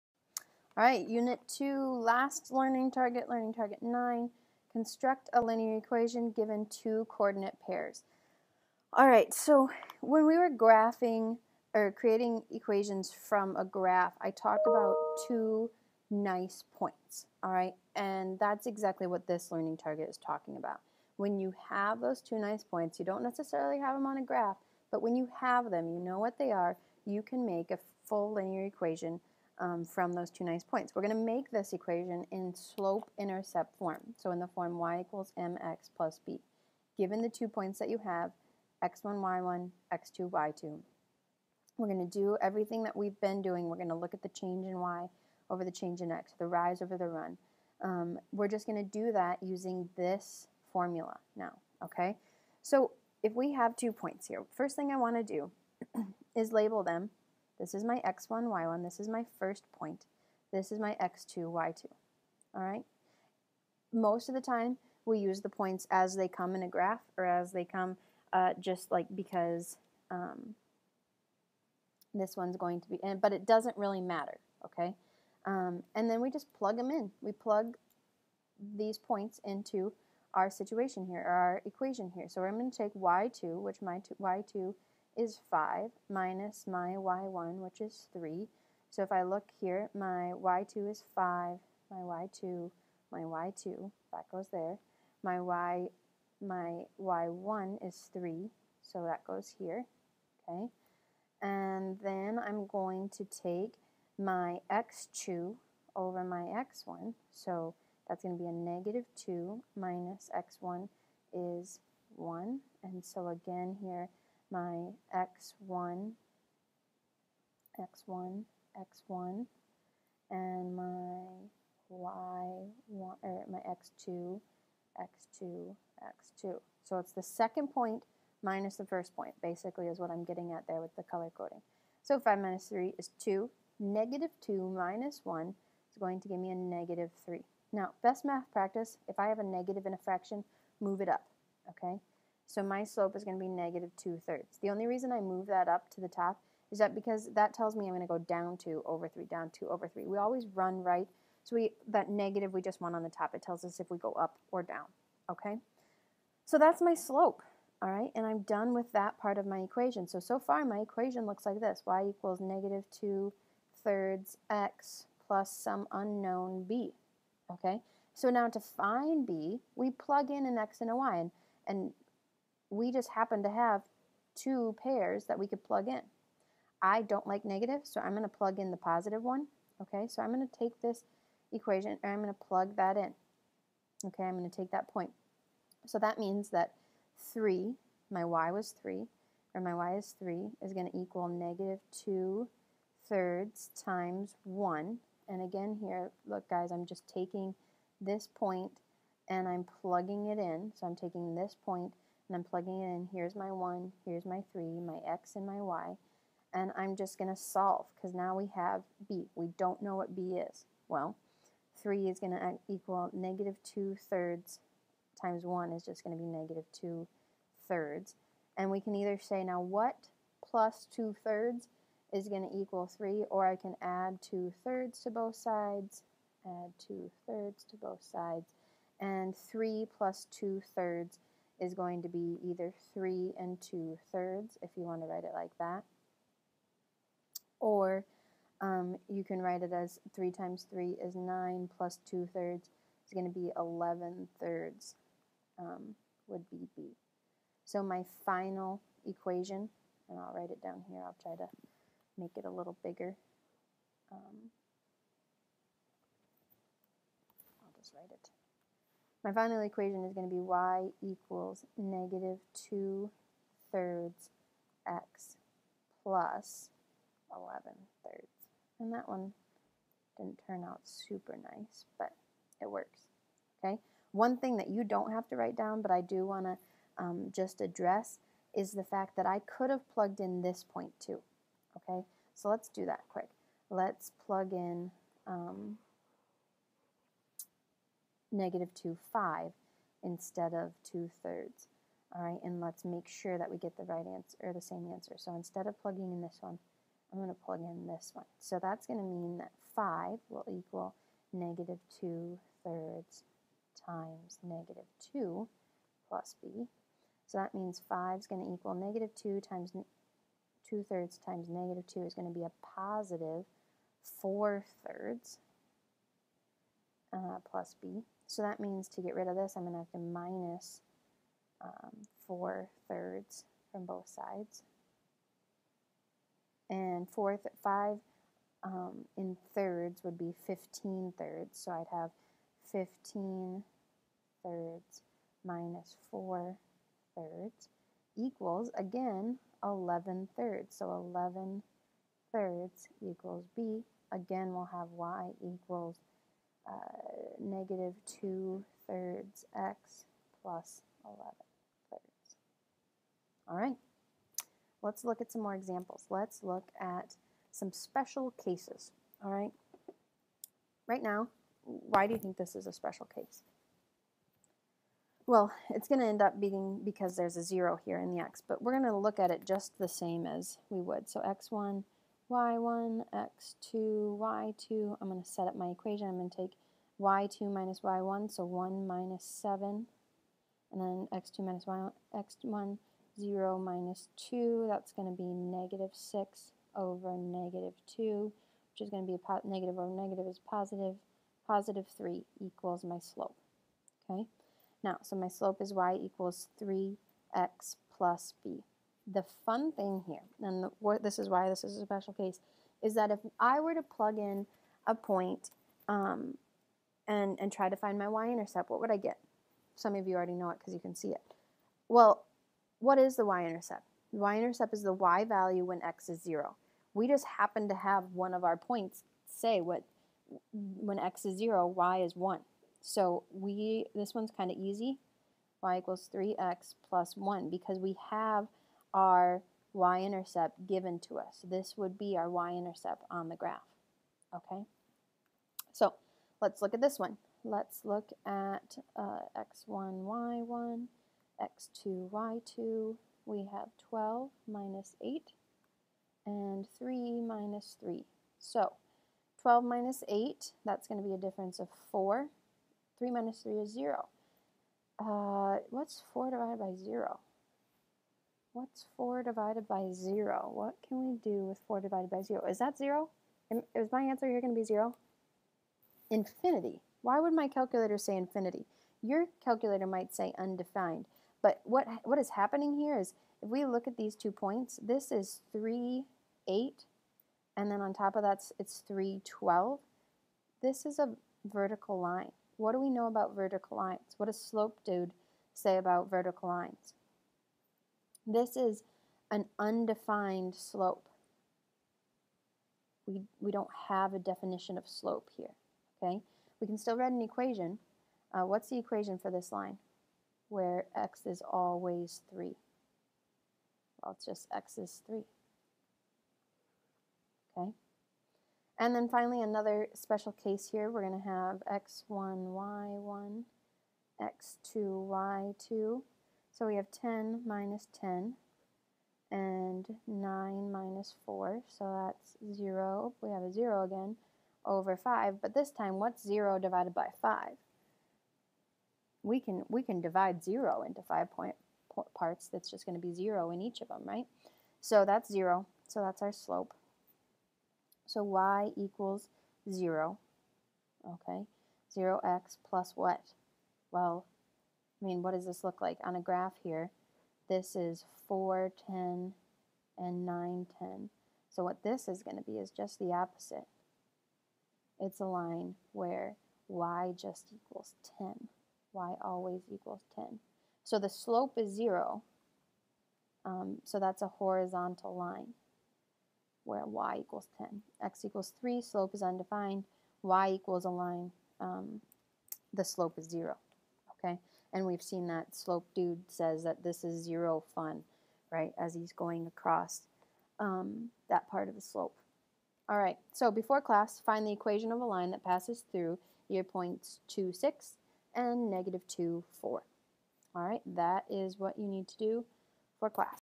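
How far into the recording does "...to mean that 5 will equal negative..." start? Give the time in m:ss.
4:58.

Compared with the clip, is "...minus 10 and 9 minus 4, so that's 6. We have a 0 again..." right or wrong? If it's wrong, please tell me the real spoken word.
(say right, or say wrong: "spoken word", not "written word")
wrong: "0", not "6".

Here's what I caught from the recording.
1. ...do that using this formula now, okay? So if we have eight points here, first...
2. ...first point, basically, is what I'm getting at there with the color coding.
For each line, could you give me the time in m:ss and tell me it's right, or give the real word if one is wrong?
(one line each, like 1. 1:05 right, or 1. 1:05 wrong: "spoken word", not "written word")
1. 0:48 wrong: "two", not "eight"
2. 2:08 right.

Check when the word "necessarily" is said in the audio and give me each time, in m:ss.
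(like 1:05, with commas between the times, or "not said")
0:23.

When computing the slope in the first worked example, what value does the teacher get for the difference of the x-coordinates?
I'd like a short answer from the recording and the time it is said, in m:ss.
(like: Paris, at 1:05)
-3, at 2:16.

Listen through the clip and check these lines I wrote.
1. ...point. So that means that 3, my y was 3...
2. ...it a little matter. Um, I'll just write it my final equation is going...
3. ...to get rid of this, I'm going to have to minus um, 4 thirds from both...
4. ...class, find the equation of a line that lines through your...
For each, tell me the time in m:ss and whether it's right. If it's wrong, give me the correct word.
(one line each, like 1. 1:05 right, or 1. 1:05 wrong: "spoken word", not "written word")
1. 3:04 right
2. 4:12 wrong: "bigger", not "matter"
3. 5:18 right
4. 9:43 wrong: "passes", not "lines".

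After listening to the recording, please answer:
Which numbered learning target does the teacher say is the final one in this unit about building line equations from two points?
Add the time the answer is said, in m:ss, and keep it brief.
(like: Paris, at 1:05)
9, at 0:03.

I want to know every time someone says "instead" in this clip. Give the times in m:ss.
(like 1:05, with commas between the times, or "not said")
4:50, 4:55.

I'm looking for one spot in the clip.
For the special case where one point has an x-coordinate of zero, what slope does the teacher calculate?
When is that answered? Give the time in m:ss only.
6:31.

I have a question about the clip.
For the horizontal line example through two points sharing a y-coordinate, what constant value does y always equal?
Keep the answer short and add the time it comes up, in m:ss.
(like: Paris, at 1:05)
10, at 9:16.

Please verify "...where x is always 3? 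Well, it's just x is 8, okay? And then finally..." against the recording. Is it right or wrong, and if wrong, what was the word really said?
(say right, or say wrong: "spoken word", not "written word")
wrong: "3", not "8".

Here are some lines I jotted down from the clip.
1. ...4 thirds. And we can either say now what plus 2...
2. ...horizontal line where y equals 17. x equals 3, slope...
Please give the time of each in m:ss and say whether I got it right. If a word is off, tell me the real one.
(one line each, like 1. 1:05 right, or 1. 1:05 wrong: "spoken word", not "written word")
1. 3:36 wrong: "2", not "4"
2. 9:24 wrong: "10", not "17".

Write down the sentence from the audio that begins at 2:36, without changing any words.
So that's my slope, all right?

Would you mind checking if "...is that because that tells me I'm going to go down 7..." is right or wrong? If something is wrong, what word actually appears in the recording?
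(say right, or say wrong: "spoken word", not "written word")
wrong: "2", not "7".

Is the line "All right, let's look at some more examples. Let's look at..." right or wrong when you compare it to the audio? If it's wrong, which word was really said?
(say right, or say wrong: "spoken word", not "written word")
right.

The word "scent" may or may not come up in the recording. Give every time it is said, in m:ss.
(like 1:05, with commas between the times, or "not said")
not said.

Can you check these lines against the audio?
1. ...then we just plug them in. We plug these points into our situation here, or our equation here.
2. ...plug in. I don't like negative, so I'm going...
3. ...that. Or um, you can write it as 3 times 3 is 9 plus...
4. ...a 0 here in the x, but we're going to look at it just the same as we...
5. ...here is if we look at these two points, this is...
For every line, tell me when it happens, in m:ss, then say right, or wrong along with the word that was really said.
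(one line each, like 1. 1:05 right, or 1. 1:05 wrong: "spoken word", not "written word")
1. 1:16 right
2. 2:55 right
3. 3:55 right
4. 6:07 right
5. 7:52 right.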